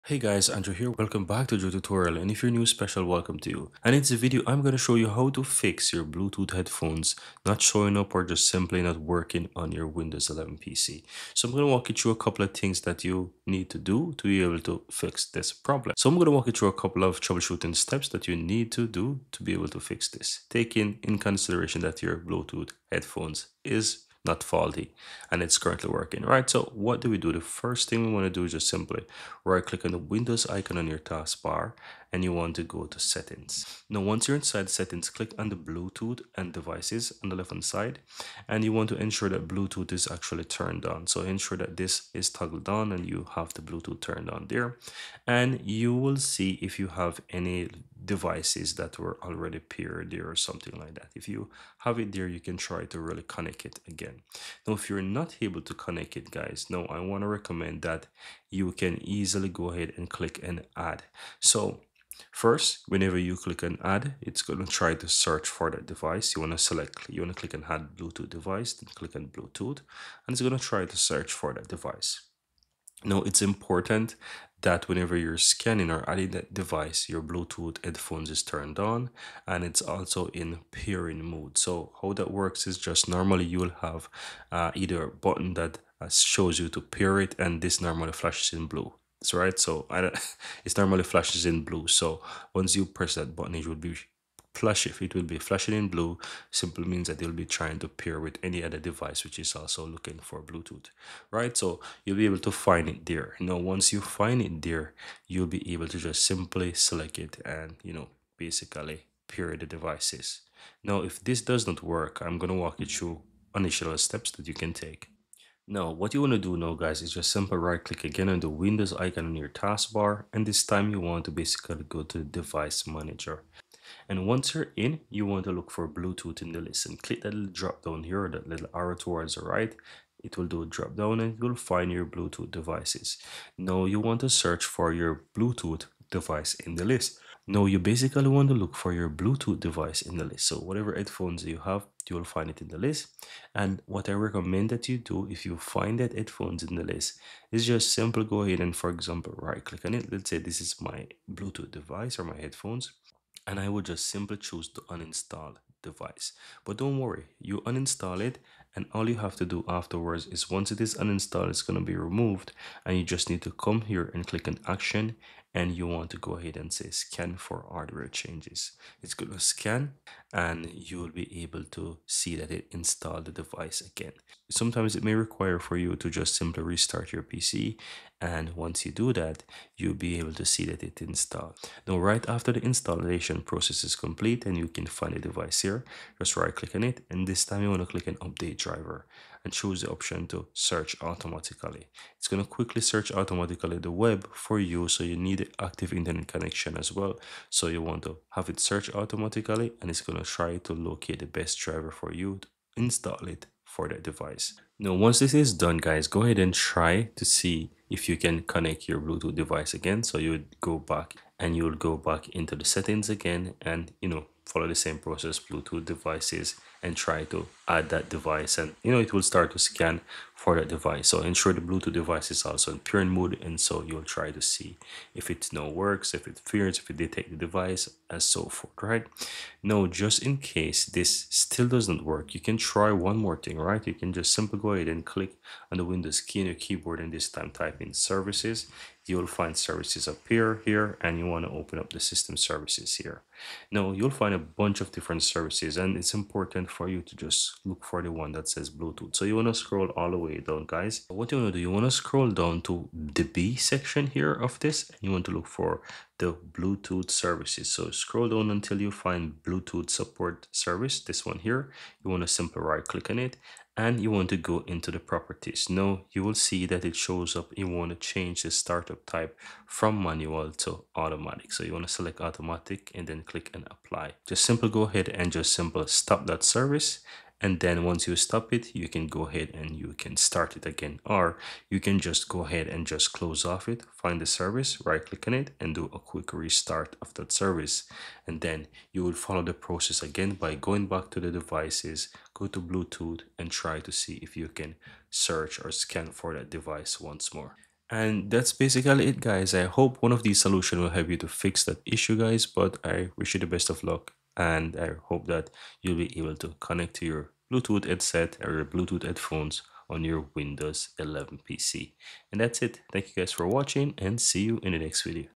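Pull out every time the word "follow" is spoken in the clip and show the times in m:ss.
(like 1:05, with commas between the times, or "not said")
3:34, 4:49.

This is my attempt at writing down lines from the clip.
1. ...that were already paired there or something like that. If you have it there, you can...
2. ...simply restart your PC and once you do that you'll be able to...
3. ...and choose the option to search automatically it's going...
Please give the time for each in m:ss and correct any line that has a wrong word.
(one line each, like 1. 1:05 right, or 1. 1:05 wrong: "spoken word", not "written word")
1. 0:48 right
2. 2:56 right
3. 3:09 right.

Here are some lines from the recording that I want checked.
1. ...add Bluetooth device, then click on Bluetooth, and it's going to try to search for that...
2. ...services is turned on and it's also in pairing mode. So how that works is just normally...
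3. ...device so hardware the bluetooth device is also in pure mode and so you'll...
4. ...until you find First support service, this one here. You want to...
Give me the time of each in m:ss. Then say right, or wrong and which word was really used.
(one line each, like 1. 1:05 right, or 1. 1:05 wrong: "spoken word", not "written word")
1. 1:07 right
2. 1:17 wrong: "headphones", not "services"
3. 3:40 wrong: "ensure", not "hardware"
4. 4:18 wrong: "Bluetooth", not "First".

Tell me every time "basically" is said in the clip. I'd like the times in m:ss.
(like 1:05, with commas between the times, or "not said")
1:48, 2:01, 2:17, 4:58.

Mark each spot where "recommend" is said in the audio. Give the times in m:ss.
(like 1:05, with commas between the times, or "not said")
0:57, 2:24.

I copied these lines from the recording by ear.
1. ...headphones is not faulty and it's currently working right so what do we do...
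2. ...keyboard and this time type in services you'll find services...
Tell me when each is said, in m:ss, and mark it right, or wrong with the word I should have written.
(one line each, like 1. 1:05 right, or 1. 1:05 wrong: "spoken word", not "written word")
1. 0:22 right
2. 3:56 right.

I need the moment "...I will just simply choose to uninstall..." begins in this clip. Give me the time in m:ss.
2:33.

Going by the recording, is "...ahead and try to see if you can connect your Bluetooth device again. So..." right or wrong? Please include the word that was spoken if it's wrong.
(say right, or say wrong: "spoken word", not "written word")
right.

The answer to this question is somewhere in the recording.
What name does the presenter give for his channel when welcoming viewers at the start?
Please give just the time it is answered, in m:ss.
0:01.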